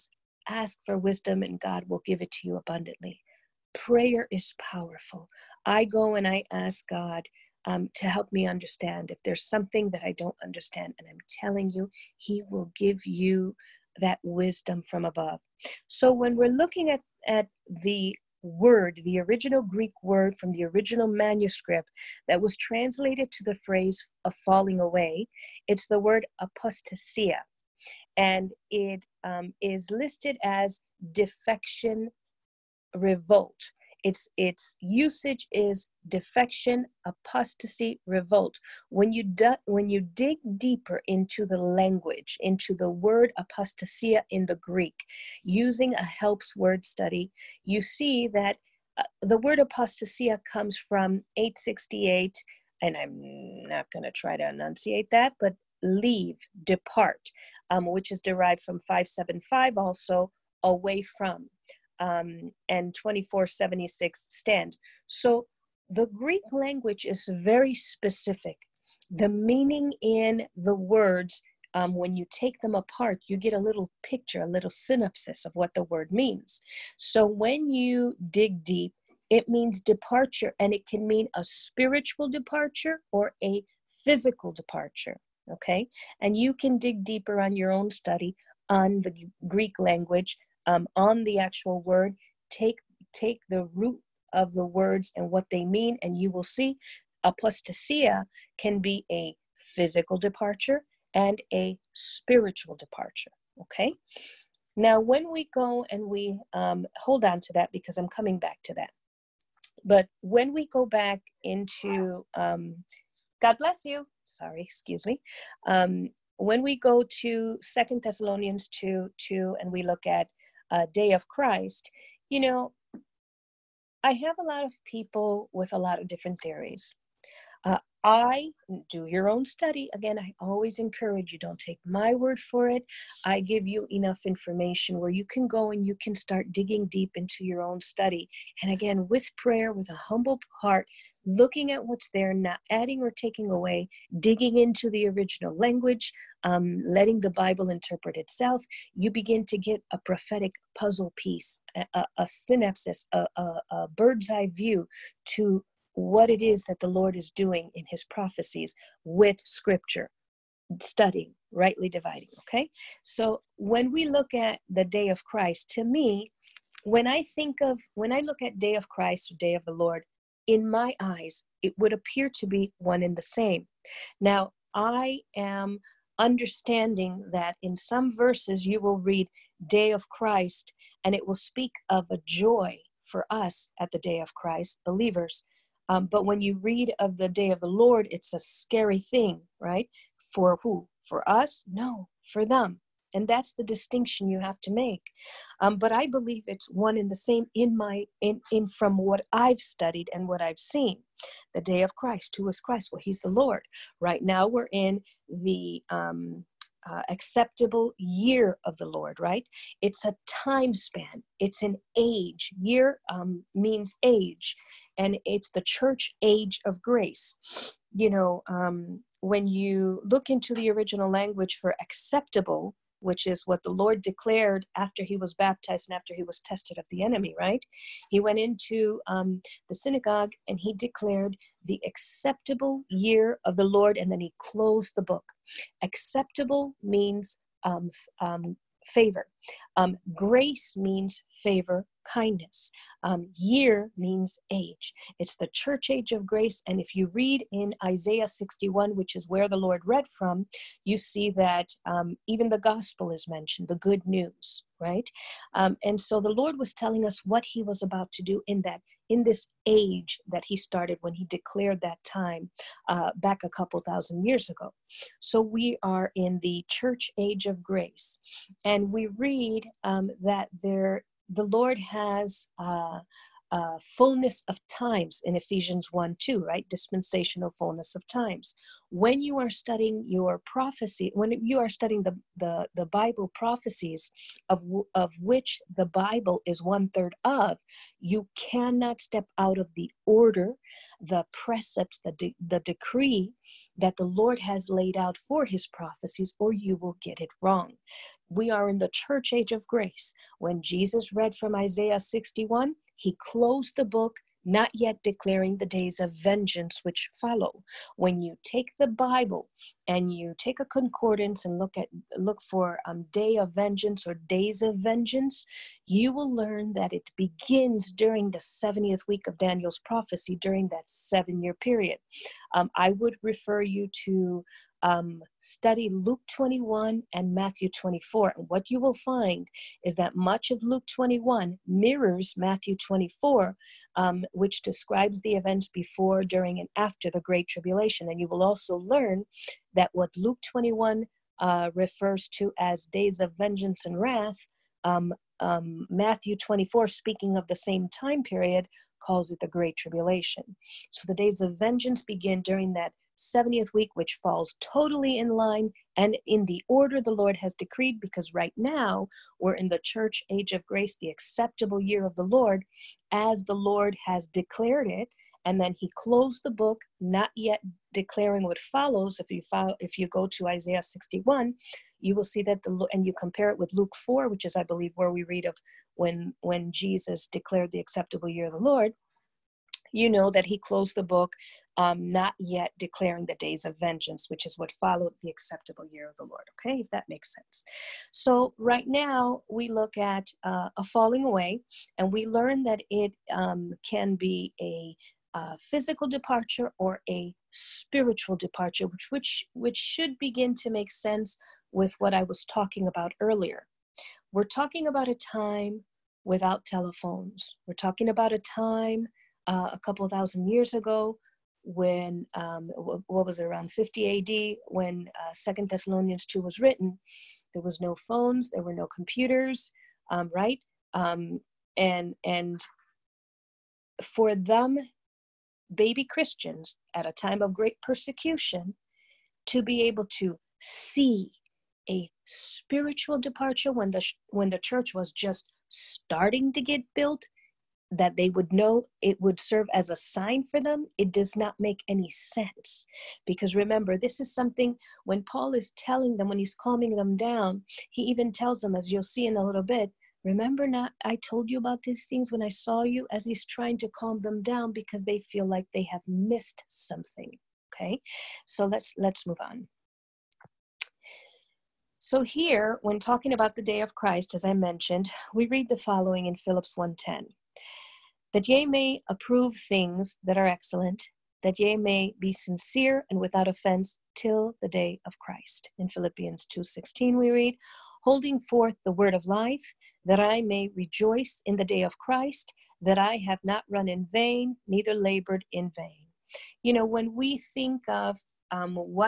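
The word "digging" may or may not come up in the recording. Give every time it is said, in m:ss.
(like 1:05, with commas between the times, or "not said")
2:16, 2:24.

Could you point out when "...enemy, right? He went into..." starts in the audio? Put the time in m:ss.
3:47.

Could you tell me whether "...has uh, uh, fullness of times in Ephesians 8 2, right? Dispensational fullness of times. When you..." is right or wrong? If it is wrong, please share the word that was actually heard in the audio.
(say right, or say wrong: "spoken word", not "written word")
wrong: "1", not "8".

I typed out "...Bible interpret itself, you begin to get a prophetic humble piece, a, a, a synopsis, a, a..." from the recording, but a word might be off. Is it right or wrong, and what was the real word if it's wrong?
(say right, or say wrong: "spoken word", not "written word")
wrong: "puzzle", not "humble".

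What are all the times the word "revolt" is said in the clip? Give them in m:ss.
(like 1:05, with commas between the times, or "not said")
0:32, 0:38.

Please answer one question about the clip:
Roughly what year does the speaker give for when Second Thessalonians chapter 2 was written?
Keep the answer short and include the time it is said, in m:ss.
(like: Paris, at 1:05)
50 AD, at 6:53.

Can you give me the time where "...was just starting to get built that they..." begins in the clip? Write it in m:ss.
7:14.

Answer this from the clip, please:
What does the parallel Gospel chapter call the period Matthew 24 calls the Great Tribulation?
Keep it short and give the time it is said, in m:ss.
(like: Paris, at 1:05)
days of vengeance and wrath, at 5:42.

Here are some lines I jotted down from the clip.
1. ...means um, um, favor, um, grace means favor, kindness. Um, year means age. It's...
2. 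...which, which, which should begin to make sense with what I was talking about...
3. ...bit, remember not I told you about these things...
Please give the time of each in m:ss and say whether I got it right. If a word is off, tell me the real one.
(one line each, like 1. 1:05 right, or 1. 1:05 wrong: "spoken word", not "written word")
1. 3:56 right
2. 6:38 right
3. 7:29 right.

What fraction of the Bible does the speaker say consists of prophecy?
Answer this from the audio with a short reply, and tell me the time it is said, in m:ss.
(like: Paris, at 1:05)
one third, at 4:46.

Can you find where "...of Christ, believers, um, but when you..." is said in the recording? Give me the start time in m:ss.
3:04.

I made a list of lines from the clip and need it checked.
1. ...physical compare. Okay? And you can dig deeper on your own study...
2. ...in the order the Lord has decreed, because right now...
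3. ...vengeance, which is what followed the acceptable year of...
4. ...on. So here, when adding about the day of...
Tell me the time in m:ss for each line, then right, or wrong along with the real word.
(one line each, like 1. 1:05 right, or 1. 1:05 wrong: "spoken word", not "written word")
1. 1:24 wrong: "departure", not "compare"
2. 5:56 right
3. 6:23 right
4. 7:39 wrong: "talking", not "adding".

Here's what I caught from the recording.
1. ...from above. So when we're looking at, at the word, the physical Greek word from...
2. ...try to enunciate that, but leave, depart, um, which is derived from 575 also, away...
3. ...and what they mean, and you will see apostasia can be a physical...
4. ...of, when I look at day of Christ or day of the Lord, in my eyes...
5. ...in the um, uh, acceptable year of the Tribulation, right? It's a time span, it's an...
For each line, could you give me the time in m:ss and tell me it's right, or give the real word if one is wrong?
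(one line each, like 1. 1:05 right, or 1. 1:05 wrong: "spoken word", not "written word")
1. 0:14 wrong: "original", not "physical"
2. 0:54 right
3. 1:35 right
4. 2:47 right
5. 3:24 wrong: "Lord", not "Tribulation".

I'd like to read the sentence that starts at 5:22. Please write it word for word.
Um, I would refer you to um, study Luke 21 and Matthew 24.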